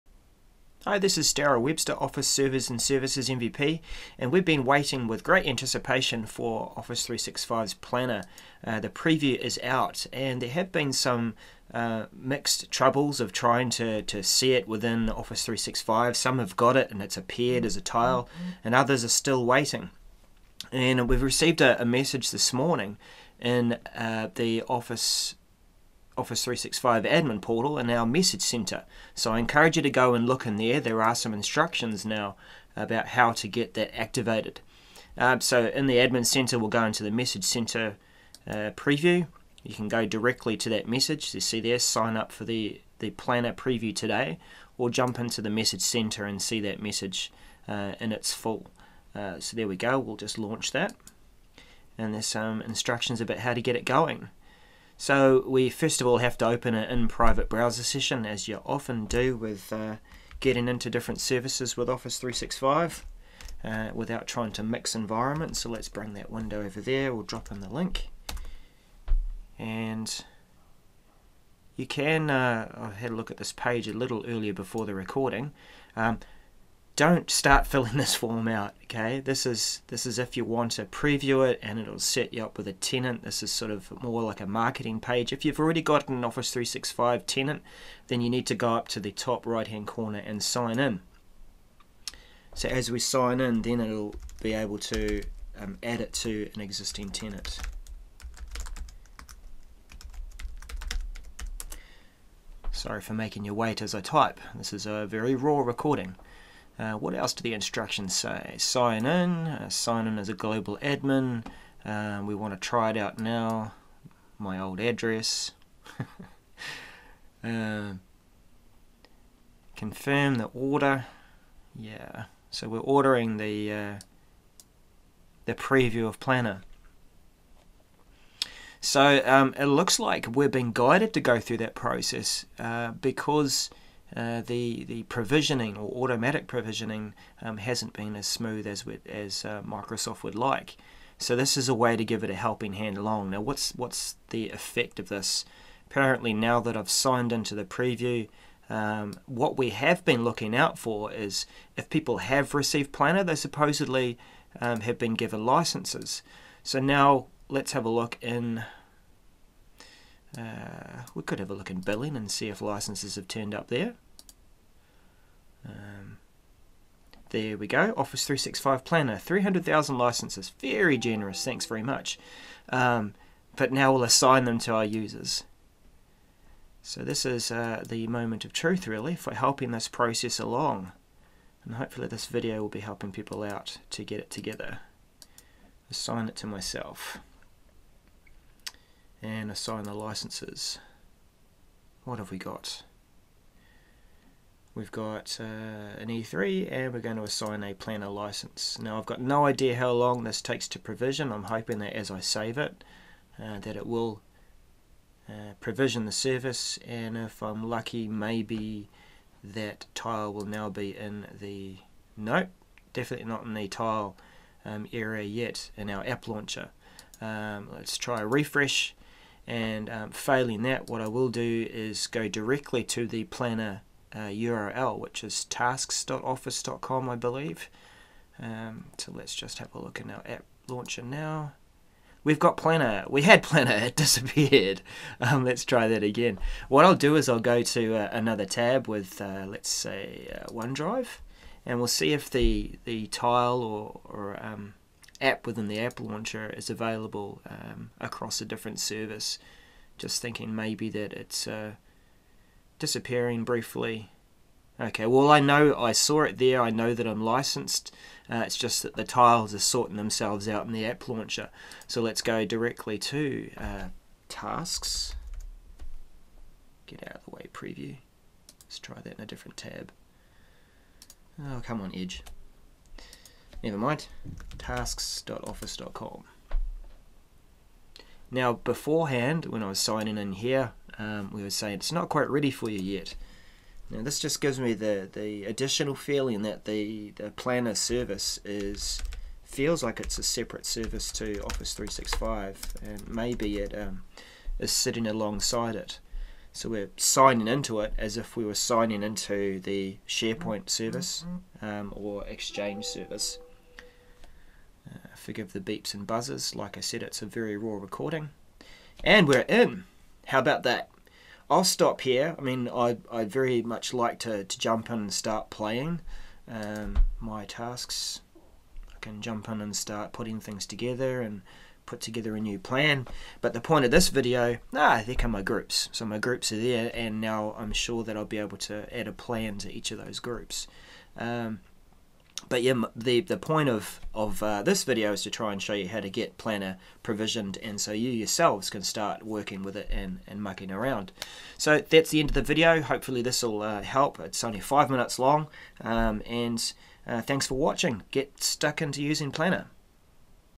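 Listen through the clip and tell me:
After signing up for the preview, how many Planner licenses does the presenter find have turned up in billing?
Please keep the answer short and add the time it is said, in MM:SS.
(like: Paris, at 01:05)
300,000, at 02:49.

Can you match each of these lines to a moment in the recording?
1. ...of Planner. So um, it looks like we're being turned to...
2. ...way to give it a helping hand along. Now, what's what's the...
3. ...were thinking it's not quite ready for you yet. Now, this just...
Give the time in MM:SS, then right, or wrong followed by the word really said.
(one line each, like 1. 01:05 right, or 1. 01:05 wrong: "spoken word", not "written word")
1. 02:06 wrong: "guided", not "turned"
2. 02:21 right
3. 04:41 wrong: "saying", not "thinking".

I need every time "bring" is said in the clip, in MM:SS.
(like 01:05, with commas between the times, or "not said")
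01:05.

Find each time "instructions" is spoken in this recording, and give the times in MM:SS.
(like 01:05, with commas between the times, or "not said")
00:31, 00:52, 01:47.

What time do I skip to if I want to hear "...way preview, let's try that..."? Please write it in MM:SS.
04:27.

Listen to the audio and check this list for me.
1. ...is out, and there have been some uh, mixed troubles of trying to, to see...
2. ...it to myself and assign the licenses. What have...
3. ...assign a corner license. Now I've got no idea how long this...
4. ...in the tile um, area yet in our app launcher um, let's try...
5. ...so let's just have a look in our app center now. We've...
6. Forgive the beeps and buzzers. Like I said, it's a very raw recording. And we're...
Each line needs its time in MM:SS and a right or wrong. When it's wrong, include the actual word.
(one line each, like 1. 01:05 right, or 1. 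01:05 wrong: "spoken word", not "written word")
1. 00:09 right
2. 03:06 right
3. 03:17 wrong: "planner", not "corner"
4. 03:33 right
5. 03:48 wrong: "launcher", not "center"
6. 05:05 right.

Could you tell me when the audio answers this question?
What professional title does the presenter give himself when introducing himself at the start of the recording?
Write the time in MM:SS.
00:02.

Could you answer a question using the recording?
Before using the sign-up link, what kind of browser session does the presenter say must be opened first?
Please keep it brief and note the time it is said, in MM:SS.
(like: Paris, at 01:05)
in-private browser session, at 00:56.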